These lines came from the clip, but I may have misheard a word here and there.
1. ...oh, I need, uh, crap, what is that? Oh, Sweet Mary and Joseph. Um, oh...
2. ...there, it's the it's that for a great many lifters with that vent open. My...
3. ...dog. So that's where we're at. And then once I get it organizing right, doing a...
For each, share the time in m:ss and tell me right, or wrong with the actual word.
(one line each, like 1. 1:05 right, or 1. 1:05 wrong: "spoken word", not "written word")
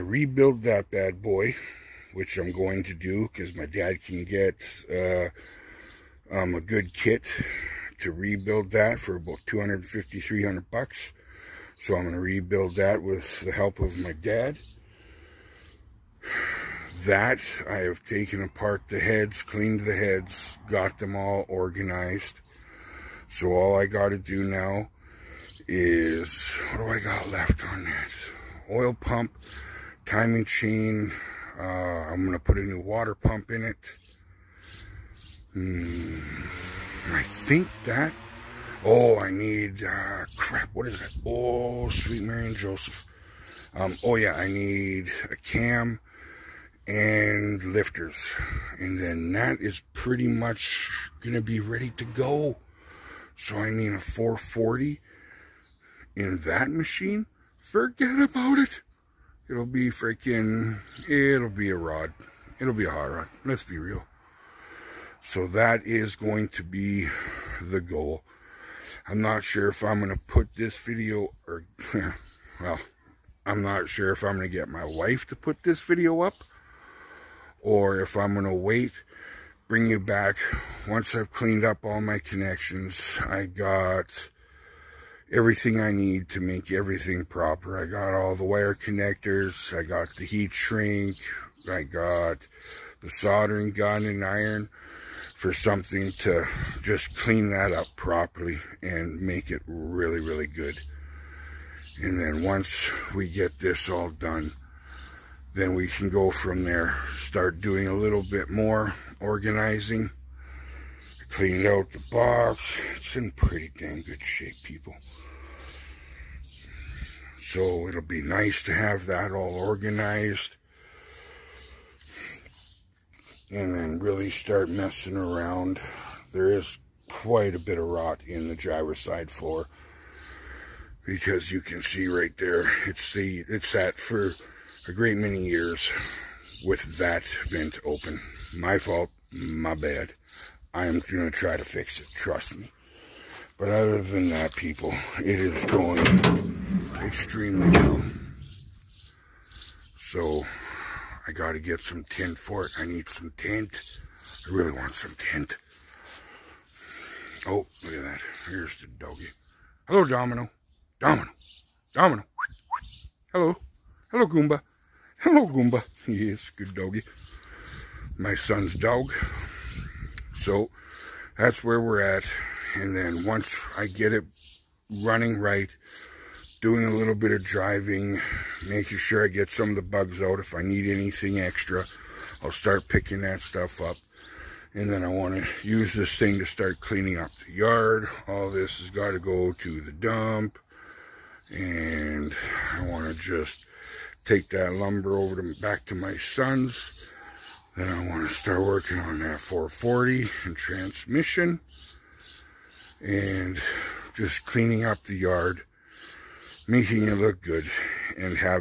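1. 0:38 right
2. 2:12 wrong: "years", not "lifters"
3. 2:48 wrong: "running", not "organizing".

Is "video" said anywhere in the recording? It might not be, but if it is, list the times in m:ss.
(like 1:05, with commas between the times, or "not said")
1:10, 1:15.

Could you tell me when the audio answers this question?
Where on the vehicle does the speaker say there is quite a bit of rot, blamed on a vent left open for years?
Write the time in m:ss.
2:08.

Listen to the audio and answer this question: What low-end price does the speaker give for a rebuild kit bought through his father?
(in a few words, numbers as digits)
250.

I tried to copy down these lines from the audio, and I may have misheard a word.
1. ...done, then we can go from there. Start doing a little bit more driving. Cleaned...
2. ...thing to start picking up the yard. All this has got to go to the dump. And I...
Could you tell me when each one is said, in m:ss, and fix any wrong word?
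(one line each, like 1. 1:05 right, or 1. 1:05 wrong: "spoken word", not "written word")
1. 1:44 wrong: "organizing", not "driving"
2. 3:06 wrong: "cleaning", not "picking".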